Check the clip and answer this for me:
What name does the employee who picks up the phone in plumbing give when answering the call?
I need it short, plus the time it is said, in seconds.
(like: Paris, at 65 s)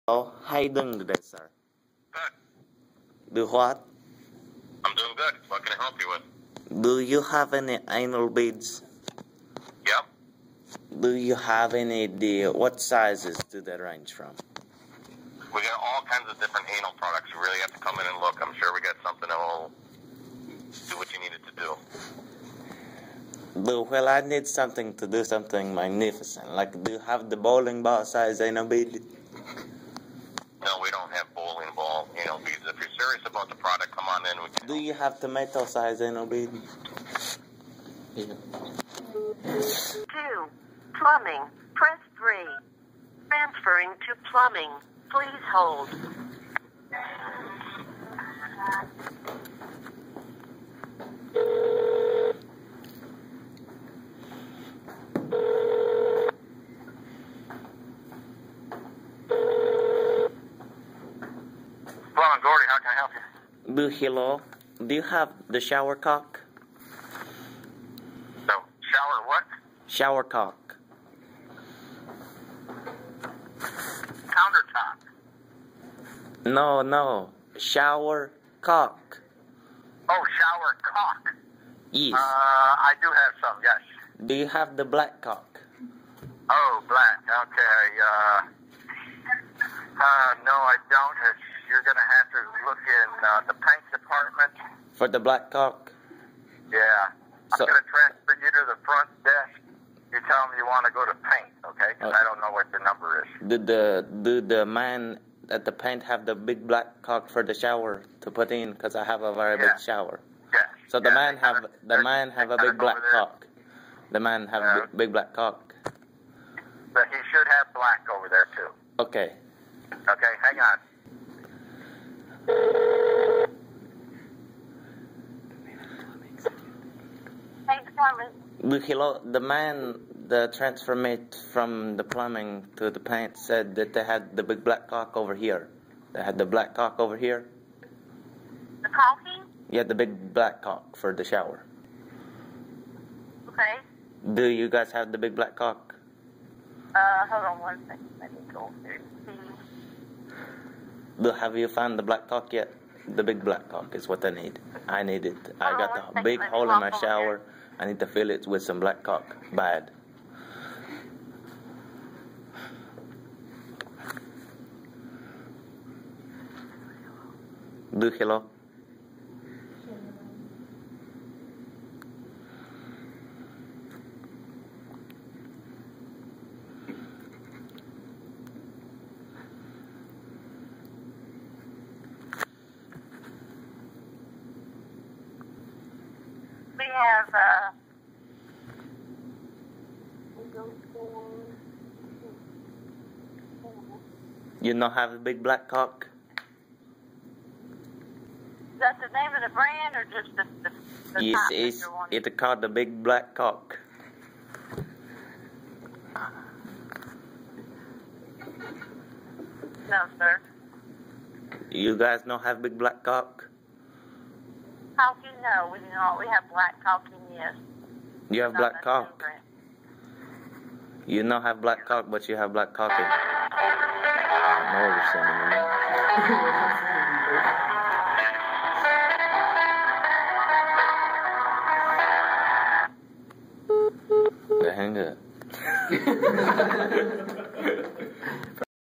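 Ron Gordy, at 62 s.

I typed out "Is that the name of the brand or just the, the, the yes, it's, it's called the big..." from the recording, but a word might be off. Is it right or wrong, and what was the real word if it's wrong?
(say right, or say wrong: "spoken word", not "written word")
right.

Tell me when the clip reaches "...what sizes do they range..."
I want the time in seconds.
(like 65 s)
12 s.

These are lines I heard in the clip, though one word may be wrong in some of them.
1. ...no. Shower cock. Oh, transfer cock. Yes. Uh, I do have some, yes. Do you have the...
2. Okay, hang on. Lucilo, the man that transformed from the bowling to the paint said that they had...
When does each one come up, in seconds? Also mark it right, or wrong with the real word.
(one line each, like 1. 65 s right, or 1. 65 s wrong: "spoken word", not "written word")
1. 76 s wrong: "shower", not "transfer"
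2. 119 s wrong: "plumbing", not "bowling".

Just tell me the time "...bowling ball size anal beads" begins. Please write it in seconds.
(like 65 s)
27 s.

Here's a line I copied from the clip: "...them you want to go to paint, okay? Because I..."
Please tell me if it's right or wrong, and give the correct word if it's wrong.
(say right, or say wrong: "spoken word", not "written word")
right.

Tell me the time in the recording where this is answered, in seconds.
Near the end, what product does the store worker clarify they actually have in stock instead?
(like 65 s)
216 s.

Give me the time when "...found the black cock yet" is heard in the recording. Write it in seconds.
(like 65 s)
151 s.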